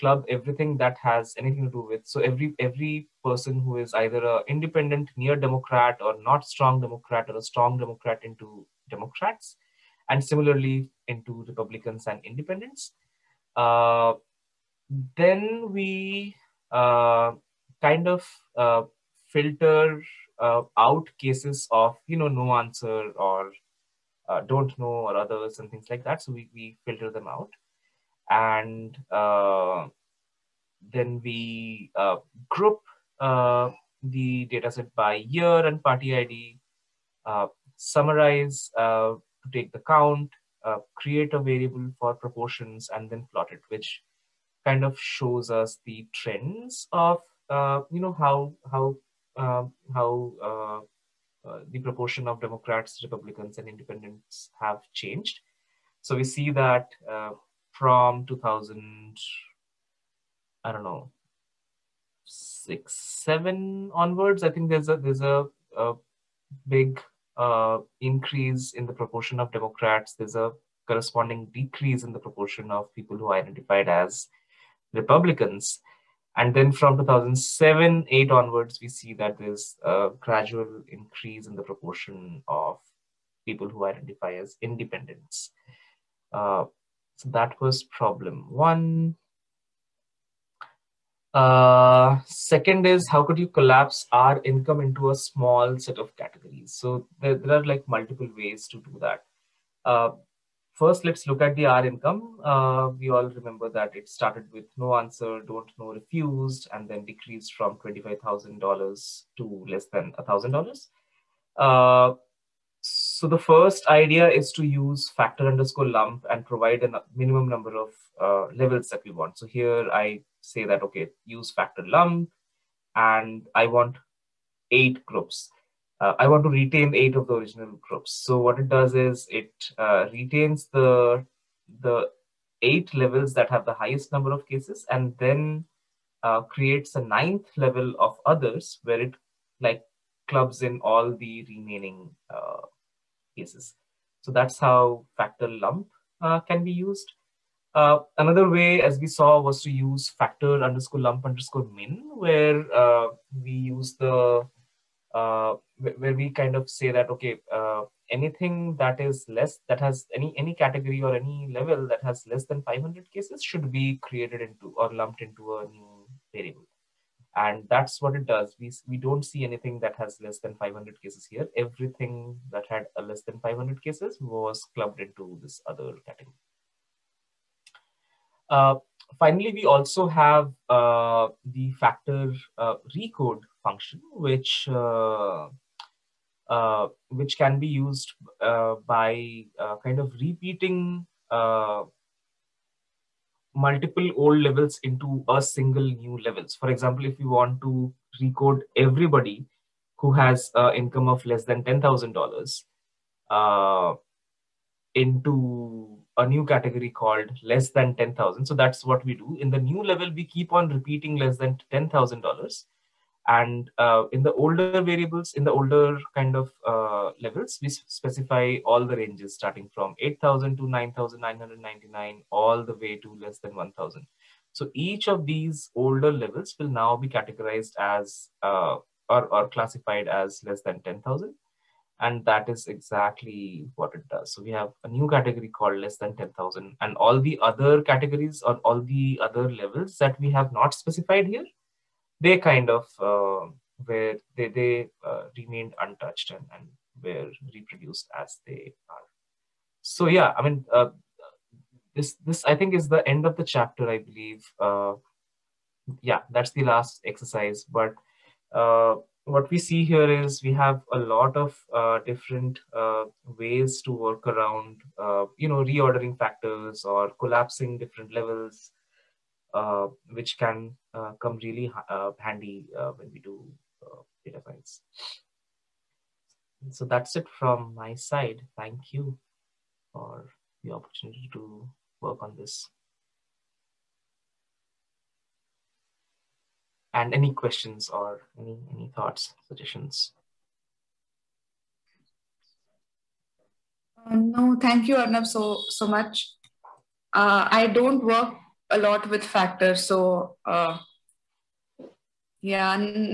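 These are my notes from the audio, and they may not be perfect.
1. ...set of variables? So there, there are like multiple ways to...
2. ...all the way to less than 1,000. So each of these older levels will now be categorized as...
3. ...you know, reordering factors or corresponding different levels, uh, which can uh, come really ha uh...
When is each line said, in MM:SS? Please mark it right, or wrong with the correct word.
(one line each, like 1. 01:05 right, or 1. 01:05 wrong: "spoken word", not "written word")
1. 01:35 wrong: "categories", not "variables"
2. 03:42 right
3. 04:25 wrong: "collapsing", not "corresponding".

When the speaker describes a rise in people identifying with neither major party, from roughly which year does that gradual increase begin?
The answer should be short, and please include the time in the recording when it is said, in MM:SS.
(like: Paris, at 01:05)
2007, at 01:16.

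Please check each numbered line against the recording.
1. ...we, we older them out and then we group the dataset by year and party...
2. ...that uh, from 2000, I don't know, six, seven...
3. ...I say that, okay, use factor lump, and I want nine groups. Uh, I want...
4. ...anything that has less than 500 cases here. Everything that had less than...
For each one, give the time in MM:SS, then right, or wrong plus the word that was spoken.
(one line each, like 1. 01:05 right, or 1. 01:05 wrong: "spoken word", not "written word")
1. 00:26 wrong: "filter", not "older"
2. 00:56 right
3. 01:59 wrong: "eight", not "nine"
4. 02:49 right.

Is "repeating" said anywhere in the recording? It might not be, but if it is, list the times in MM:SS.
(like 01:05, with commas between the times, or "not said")
03:10, 03:30.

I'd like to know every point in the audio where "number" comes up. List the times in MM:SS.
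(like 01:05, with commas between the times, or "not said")
01:57, 02:14.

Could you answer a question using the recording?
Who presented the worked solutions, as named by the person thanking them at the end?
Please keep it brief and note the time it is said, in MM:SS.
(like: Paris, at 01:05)
Arnab, at 04:54.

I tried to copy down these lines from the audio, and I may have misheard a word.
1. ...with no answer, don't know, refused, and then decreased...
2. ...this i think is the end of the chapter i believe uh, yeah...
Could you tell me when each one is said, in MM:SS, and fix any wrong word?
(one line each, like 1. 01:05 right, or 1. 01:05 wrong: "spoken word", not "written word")
1. 01:44 right
2. 04:12 right.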